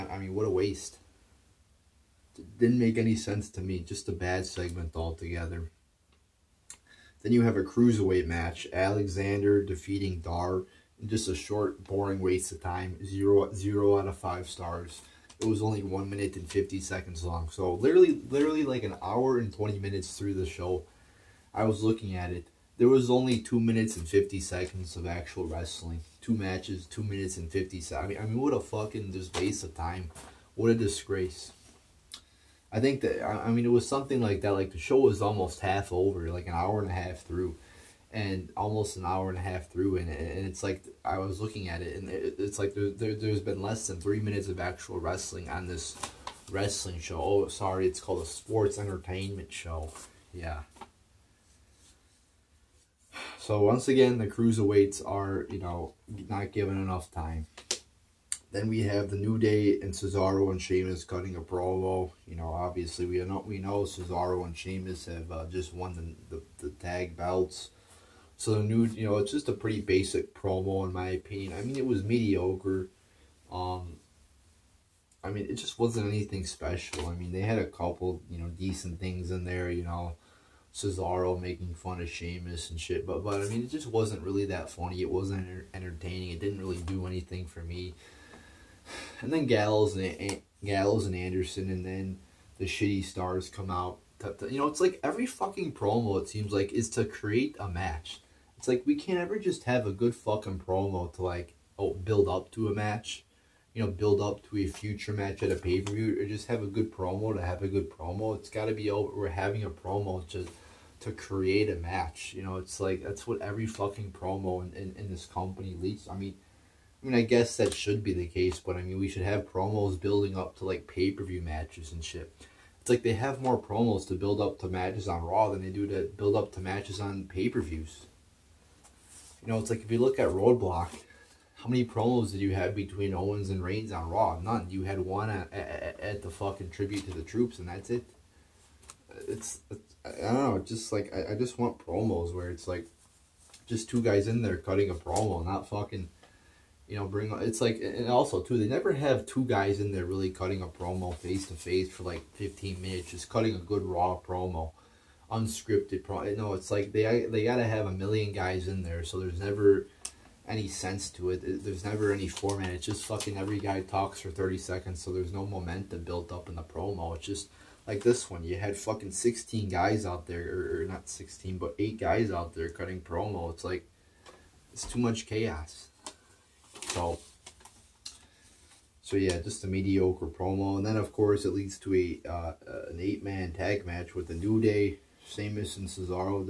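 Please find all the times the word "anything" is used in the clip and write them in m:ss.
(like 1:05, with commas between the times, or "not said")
1:16, 1:27.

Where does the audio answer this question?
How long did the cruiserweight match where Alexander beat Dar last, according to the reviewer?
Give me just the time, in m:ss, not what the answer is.
0:15.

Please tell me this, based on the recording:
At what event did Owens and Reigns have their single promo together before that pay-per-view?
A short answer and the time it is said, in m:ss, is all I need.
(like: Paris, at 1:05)
Tribute to the Troops, at 2:16.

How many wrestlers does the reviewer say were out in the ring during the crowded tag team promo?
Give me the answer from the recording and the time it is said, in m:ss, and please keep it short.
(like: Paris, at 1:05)
8, at 2:51.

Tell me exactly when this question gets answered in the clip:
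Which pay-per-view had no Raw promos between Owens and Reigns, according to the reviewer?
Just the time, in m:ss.
2:10.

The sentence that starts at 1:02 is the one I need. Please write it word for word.
You know, obviously we know we know Cesaro and Sheamus have uh, just won the, the, the tag belts.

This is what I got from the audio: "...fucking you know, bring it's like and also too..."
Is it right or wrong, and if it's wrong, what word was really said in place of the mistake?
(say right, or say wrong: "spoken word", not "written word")
right.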